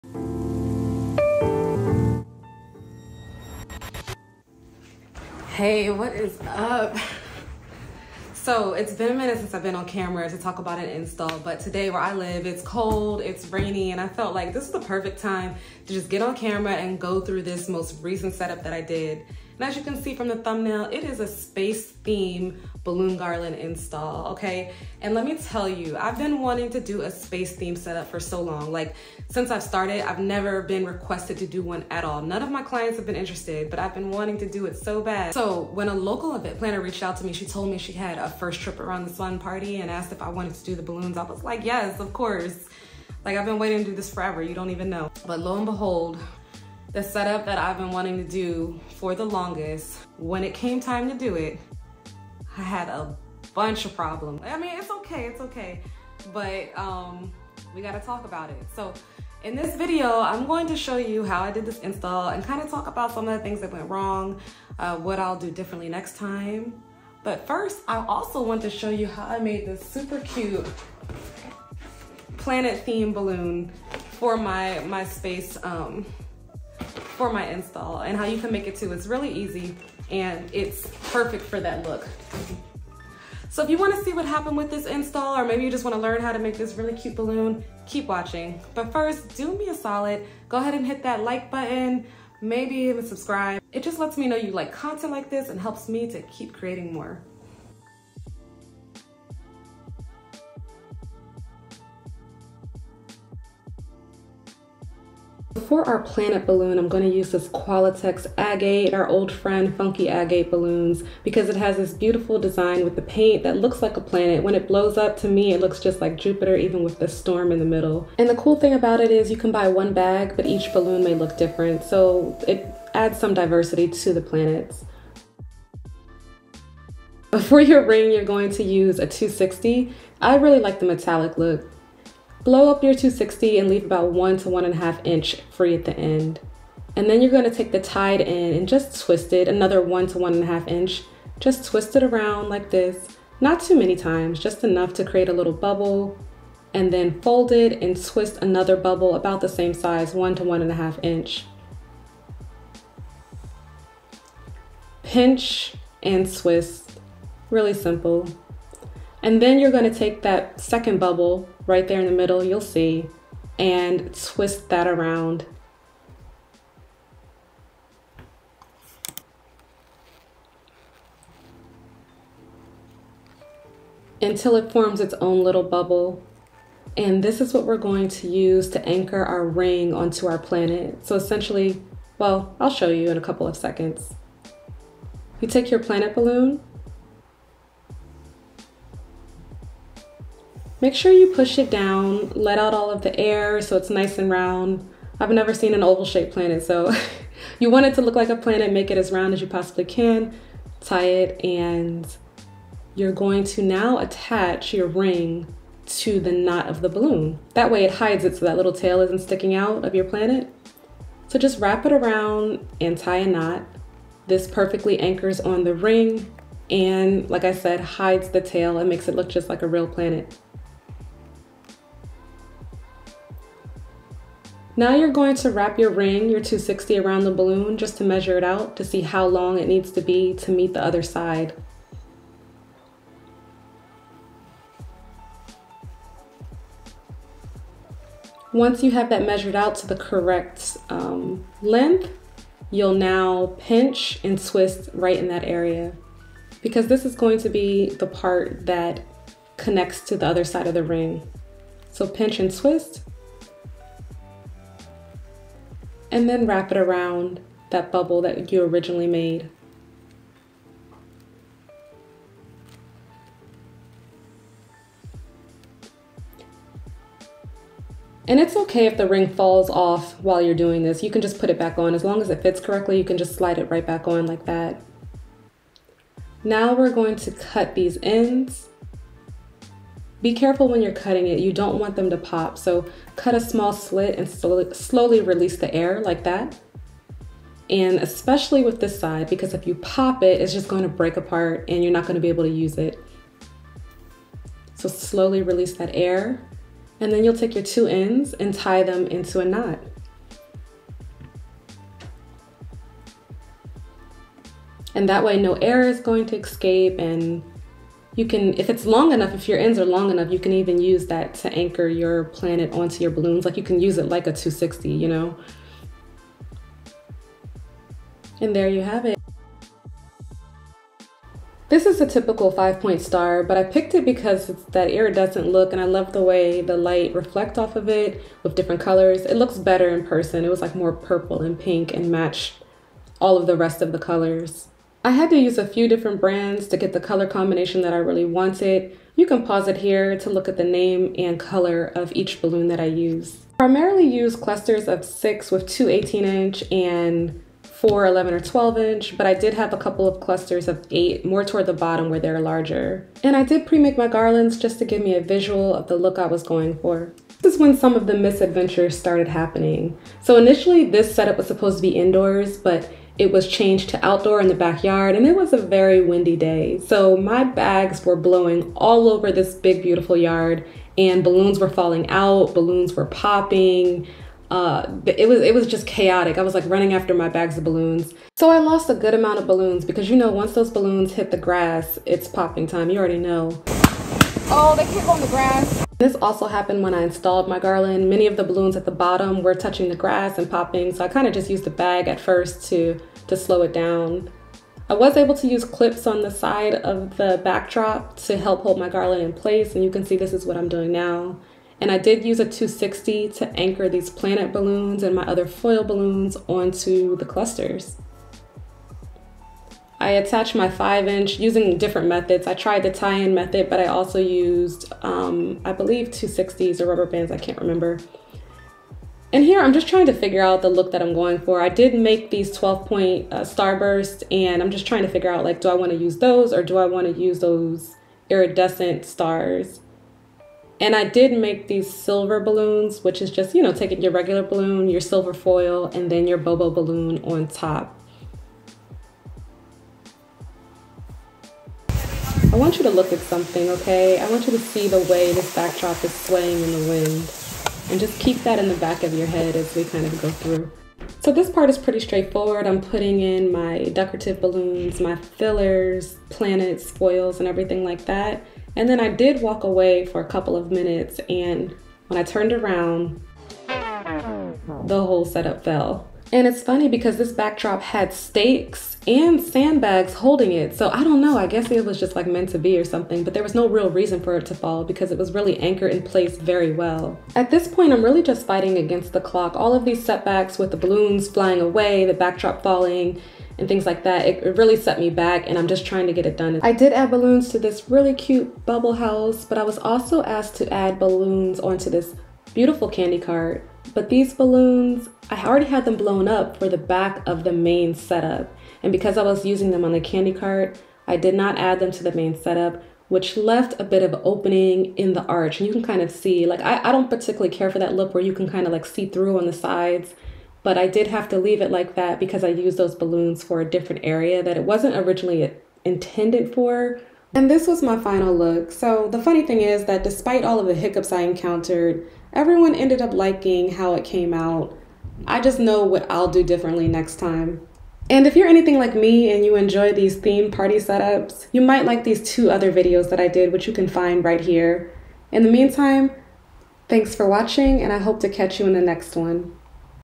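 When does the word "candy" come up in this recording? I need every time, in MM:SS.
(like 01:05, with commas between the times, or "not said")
08:12, 08:20.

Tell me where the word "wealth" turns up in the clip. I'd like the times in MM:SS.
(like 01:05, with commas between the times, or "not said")
not said.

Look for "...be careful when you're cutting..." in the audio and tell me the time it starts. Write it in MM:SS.
04:40.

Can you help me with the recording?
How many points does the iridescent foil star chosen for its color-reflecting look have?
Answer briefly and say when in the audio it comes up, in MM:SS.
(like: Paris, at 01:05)
5, at 05:22.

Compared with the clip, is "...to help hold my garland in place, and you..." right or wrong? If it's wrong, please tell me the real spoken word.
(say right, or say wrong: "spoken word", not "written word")
right.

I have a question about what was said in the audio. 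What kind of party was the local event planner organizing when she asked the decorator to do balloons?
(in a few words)
First trip around the sun party.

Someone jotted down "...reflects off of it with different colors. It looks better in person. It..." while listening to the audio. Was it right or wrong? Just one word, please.
right.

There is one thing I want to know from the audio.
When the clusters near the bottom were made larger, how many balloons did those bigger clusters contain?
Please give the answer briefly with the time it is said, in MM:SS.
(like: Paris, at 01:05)
8, at 05:50.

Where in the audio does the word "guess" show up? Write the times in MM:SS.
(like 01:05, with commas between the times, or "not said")
07:51.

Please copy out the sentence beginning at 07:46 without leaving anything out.
And it's funny because this backdrop had stakes and sandbags holding it.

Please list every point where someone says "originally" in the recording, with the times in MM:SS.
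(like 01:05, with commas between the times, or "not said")
04:18, 08:34.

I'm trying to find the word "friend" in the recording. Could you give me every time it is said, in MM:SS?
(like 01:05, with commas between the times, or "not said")
01:49.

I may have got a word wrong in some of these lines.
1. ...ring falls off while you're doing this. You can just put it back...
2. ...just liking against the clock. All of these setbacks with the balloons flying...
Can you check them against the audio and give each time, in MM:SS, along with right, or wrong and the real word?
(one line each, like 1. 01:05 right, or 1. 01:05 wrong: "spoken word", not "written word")
1. 04:29 right
2. 07:58 wrong: "fighting", not "liking".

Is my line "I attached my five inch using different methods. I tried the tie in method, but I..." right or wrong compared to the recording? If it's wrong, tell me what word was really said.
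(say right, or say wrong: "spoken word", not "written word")
right.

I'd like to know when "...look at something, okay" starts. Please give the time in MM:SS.
07:22.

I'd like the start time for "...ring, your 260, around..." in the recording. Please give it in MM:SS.
03:45.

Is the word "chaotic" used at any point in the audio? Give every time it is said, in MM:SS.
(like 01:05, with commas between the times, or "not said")
06:15.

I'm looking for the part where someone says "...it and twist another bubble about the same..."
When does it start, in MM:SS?
02:27.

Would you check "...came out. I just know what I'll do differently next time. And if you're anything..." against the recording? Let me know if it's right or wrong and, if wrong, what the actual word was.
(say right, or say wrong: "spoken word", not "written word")
right.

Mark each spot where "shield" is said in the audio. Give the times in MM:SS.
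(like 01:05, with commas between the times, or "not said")
not said.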